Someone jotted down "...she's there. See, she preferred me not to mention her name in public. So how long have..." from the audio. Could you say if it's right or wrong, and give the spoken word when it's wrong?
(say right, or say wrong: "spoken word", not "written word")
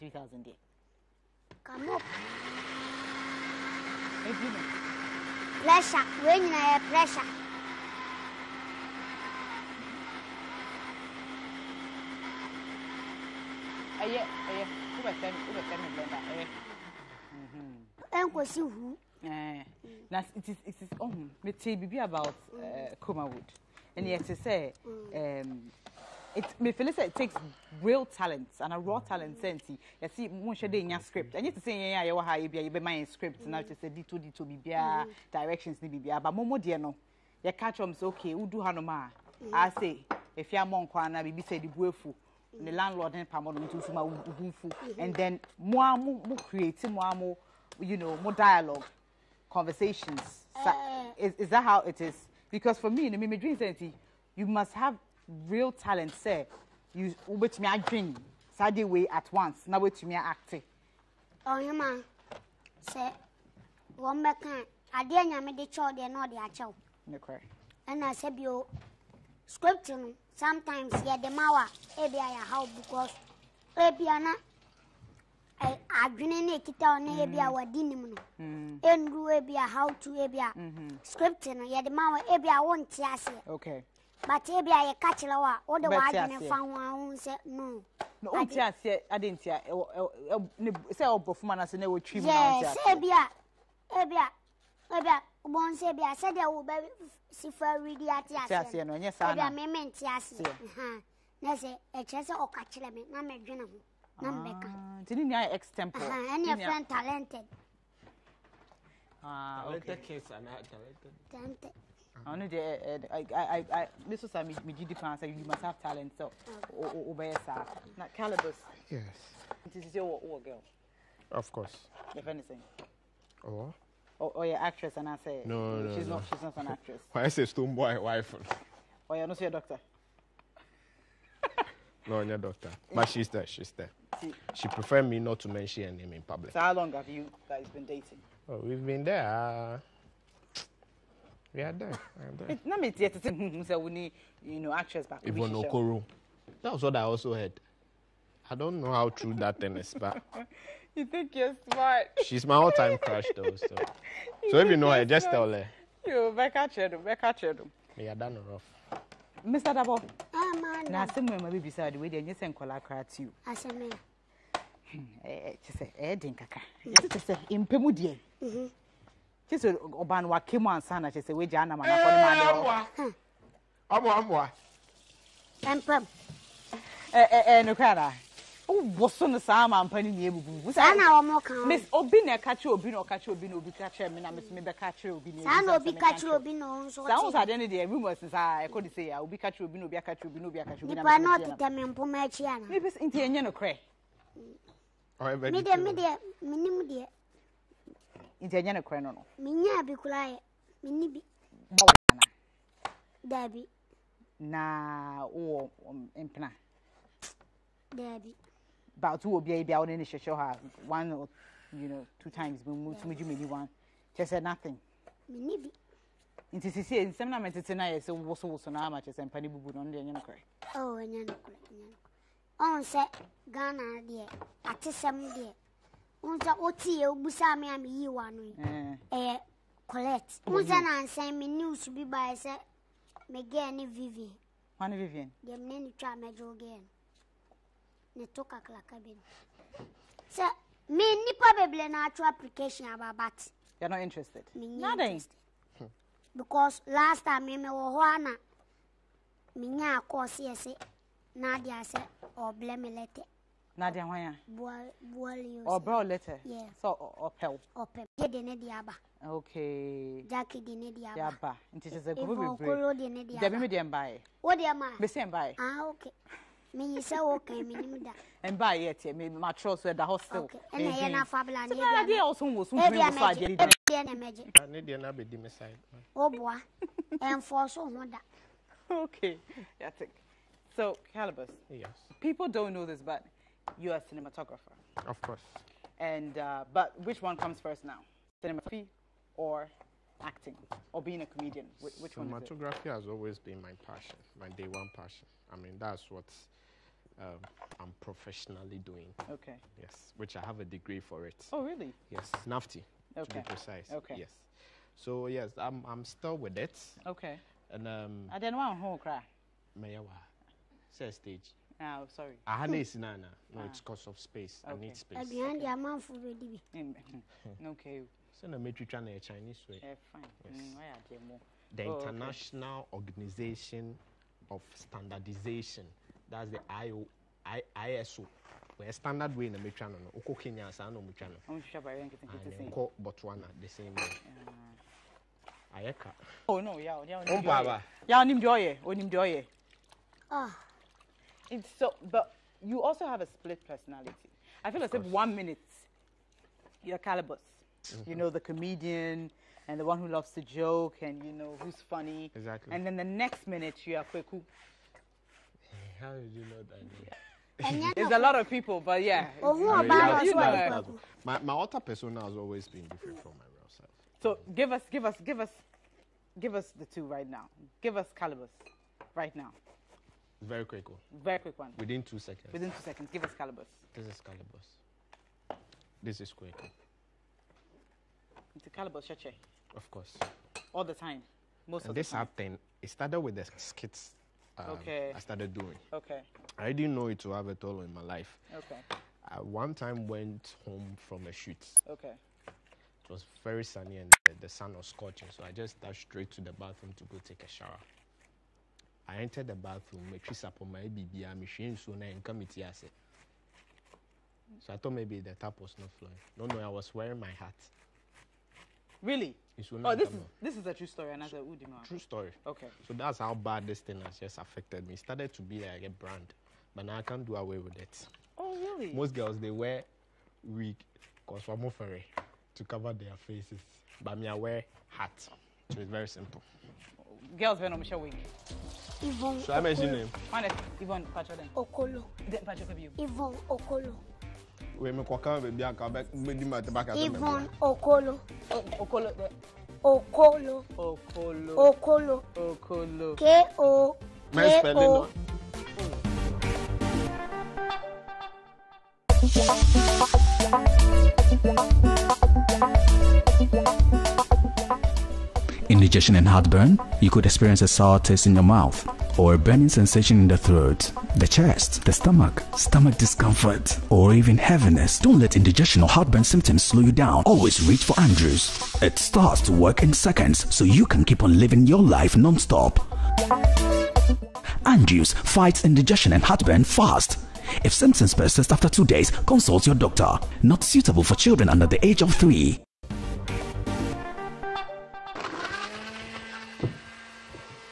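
right.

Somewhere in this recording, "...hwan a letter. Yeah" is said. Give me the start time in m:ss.
4:14.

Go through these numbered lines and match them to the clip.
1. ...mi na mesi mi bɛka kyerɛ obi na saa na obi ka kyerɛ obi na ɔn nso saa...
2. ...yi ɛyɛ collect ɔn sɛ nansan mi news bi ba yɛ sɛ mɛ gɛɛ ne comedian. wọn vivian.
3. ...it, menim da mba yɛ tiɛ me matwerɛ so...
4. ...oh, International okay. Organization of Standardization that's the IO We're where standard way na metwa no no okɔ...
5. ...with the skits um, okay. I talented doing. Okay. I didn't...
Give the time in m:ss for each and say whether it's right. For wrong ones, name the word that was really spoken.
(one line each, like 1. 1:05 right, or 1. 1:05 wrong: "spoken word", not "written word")
1. 3:04 right
2. 3:48 wrong: "vivian", not "comedian"
3. 4:27 right
4. 5:21 right
5. 6:23 wrong: "started", not "talented".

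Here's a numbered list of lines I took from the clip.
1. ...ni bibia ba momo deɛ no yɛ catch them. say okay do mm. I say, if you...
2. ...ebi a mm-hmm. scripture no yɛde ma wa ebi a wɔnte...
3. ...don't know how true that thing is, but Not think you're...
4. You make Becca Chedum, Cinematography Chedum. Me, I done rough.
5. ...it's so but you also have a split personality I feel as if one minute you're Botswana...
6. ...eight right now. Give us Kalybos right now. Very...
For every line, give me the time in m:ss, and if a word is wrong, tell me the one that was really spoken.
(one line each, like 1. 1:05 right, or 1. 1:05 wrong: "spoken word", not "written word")
1. 0:35 right
2. 1:20 right
3. 2:28 wrong: "You", not "Not"
4. 2:36 wrong: "Becca", not "Cinematography"
5. 5:41 wrong: "Kalybos", not "Botswana"
6. 6:06 wrong: "two", not "eight".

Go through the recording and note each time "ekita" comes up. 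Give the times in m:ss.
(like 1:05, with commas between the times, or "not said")
1:16.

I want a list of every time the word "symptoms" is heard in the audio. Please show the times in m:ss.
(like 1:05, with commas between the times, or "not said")
7:46, 7:57.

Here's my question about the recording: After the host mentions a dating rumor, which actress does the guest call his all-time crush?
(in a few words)
Yvonne Okoro.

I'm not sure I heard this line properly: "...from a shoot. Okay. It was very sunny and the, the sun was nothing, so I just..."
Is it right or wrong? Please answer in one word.
wrong.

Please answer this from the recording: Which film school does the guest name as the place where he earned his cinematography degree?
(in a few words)
NAFTI.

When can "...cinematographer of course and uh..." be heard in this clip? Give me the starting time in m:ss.
4:44.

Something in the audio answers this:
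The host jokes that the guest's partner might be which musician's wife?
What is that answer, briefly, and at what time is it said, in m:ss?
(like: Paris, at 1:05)
Stonebwoy, at 2:07.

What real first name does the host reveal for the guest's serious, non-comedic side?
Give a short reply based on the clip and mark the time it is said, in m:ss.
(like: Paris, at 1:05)
Kweku, at 5:54.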